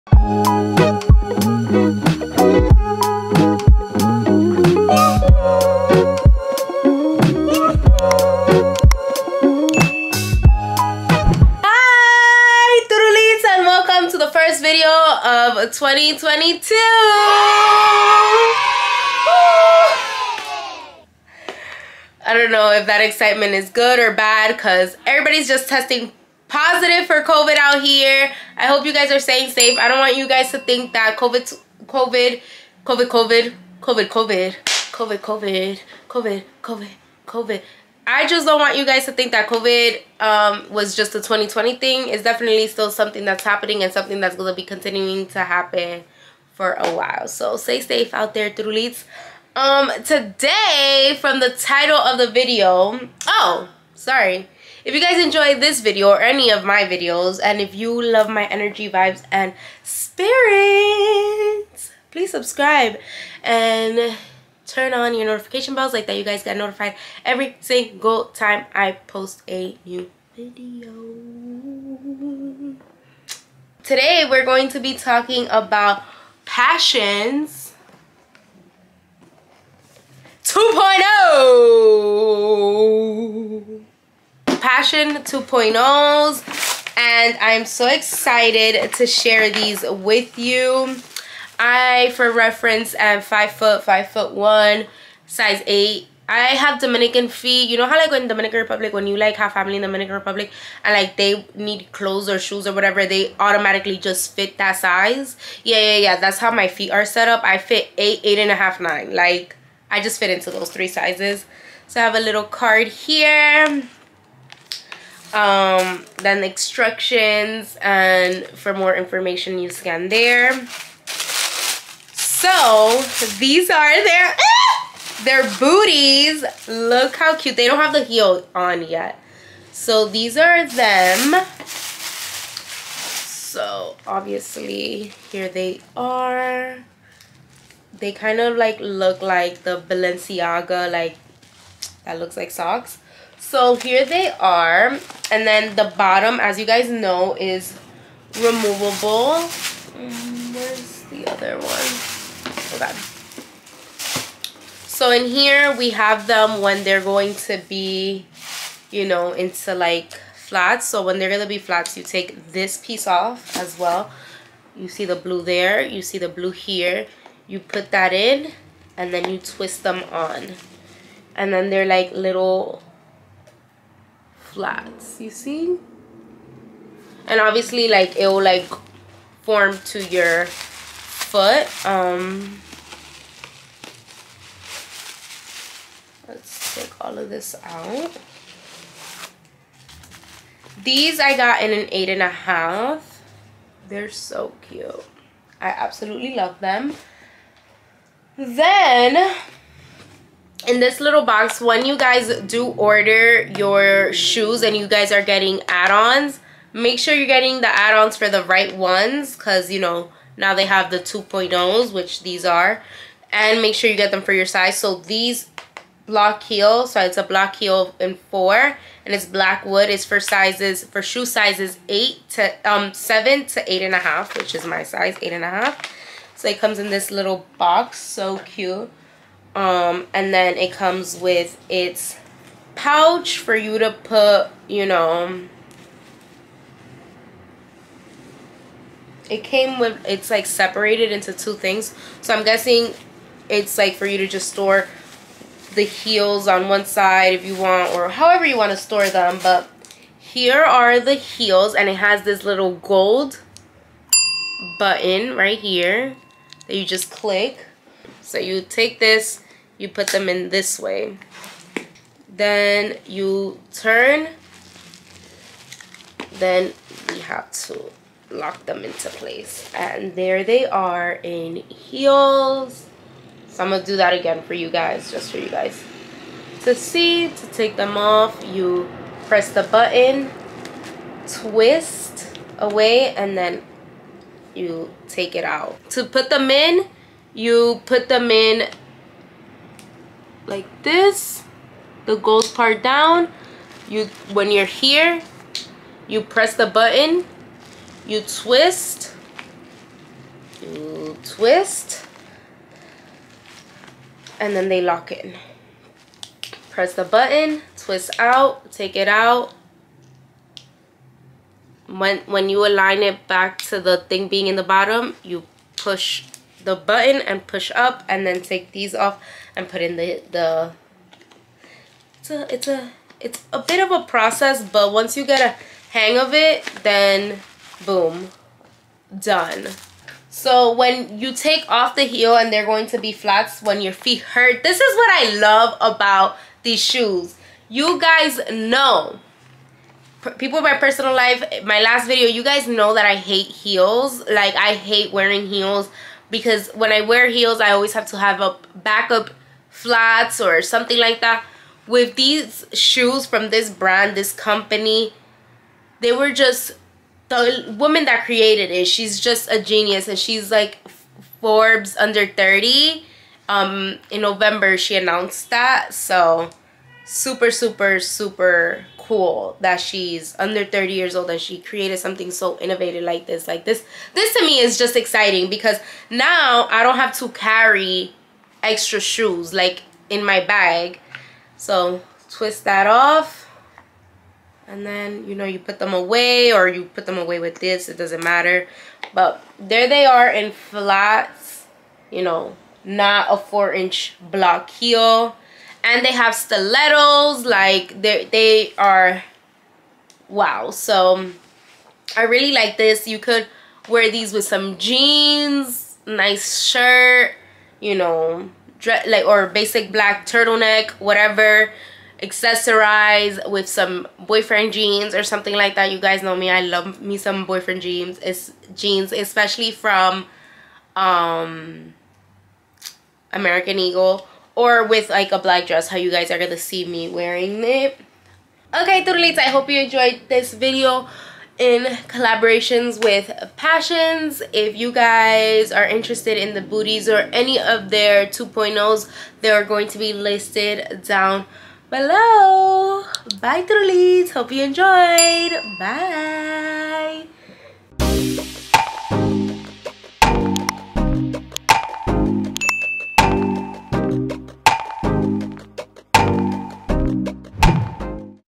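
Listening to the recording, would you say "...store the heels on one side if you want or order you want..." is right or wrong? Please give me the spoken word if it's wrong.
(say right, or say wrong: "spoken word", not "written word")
wrong: "however", not "order".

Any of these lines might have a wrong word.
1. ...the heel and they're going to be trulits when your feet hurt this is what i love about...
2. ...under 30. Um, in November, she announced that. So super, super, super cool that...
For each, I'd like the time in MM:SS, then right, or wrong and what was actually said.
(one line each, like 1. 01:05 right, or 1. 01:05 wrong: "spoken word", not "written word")
1. 05:31 wrong: "flats", not "trulits"
2. 06:01 right.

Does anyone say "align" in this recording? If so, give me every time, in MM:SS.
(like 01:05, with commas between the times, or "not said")
05:12.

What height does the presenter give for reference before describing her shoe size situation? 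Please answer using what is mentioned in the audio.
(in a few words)
5 foot 1.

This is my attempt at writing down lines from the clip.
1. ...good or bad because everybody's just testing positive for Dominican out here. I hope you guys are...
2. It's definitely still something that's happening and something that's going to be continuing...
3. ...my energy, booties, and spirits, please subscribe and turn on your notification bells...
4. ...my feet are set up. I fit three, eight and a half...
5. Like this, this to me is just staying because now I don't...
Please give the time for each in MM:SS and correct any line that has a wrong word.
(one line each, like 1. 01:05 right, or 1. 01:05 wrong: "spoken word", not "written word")
1. 00:23 wrong: "COVID", not "Dominican"
2. 00:42 right
3. 00:58 wrong: "vibes", not "booties"
4. 01:46 wrong: "eight", not "three"
5. 06:13 wrong: "exciting", not "staying".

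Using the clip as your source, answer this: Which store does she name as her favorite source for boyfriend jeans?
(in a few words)
American Eagle.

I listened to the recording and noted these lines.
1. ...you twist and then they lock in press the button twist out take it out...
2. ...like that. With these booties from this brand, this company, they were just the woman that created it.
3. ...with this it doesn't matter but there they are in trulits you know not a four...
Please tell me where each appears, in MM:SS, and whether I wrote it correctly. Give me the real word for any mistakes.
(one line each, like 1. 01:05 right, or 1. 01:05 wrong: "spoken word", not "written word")
1. 05:00 right
2. 05:50 wrong: "shoes", not "booties"
3. 06:27 wrong: "flats", not "trulits".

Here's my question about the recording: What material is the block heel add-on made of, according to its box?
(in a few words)
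black wood.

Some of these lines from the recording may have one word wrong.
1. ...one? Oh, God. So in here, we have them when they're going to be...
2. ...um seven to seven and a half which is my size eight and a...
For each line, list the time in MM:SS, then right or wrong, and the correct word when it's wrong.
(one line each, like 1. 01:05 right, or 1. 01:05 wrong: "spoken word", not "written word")
1. 02:31 right
2. 03:42 wrong: "eight", not "seven".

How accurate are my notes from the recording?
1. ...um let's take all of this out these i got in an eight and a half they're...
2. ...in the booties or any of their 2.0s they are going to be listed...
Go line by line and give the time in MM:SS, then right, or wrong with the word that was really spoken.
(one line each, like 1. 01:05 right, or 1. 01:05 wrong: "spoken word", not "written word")
1. 03:01 right
2. 07:16 right.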